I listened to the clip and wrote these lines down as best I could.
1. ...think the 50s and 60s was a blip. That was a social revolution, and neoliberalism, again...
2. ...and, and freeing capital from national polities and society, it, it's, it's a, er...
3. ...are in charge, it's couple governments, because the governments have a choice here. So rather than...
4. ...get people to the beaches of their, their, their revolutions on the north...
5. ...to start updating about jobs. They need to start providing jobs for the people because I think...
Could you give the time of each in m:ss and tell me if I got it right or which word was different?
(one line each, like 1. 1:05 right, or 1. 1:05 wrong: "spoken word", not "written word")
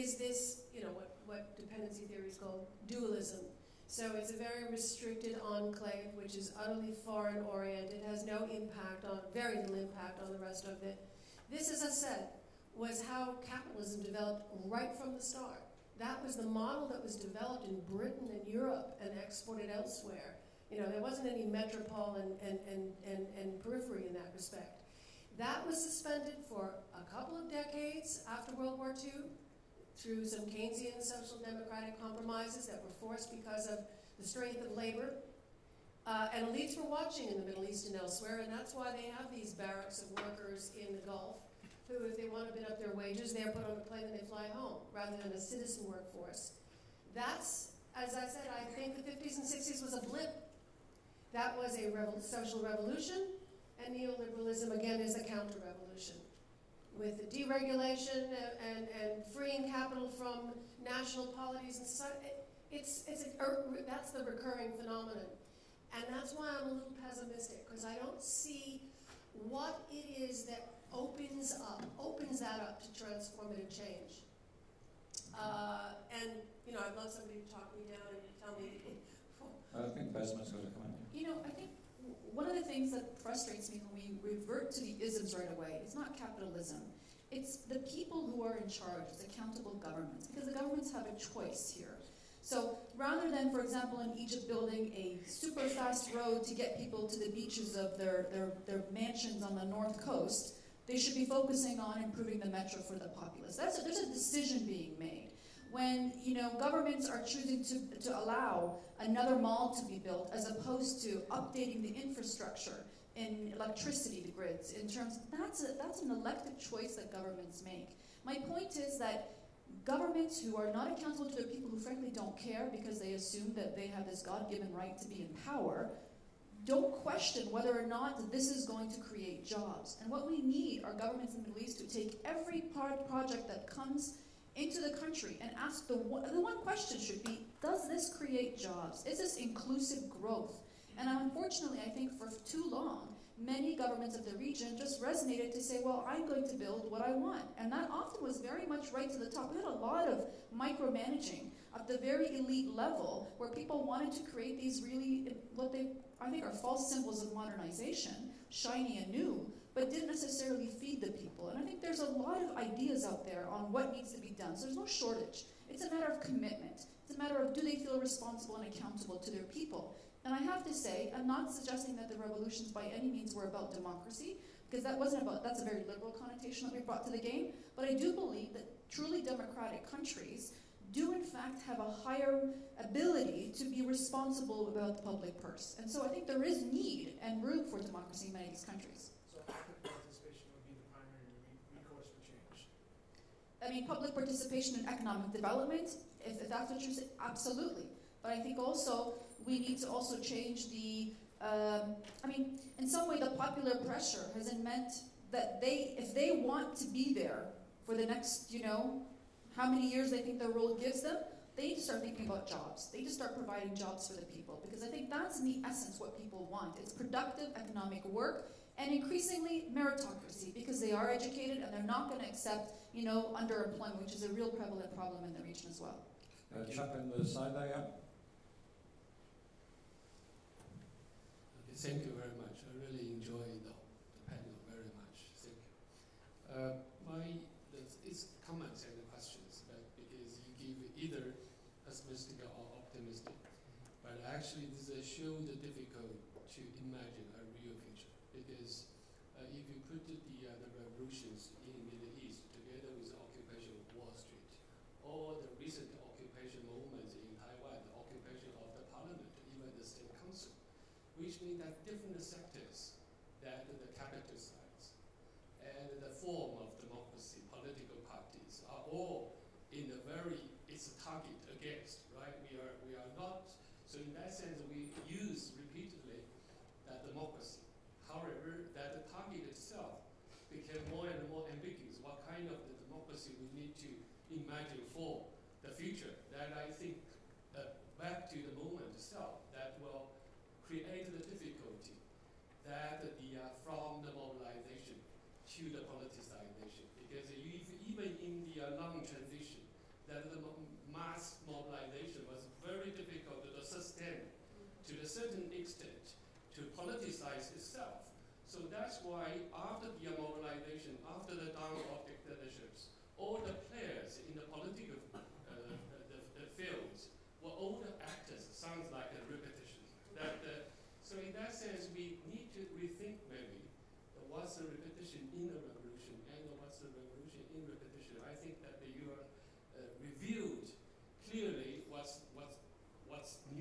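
1. 0:48 right
2. 0:58 right
3. 1:28 wrong: "accountable", not "couple"
4. 1:36 wrong: "mansions", not "revolutions"
5. 3:31 wrong: "thinking", not "updating".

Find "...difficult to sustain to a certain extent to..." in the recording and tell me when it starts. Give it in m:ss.
5:02.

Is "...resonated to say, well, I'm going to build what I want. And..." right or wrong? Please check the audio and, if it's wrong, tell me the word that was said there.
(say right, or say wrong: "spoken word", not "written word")
right.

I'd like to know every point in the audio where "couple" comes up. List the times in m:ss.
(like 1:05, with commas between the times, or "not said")
0:27.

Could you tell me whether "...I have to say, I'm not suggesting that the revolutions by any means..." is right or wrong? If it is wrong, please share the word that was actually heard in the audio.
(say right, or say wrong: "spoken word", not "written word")
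right.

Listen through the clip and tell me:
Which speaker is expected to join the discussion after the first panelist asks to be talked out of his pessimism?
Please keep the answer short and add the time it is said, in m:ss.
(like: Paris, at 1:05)
Bessma, at 1:20.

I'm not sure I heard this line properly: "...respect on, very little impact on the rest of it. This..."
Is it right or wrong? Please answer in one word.
wrong.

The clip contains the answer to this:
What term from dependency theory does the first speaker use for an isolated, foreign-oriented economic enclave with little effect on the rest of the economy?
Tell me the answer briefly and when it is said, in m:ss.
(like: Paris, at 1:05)
Dualism, at 0:02.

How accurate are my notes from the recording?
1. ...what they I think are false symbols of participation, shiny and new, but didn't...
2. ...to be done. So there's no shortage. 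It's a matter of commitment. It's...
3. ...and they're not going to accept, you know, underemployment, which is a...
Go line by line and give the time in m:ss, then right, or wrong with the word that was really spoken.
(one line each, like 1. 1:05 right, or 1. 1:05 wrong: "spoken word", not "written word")
1. 2:35 wrong: "modernization", not "participation"
2. 2:44 right
3. 3:41 right.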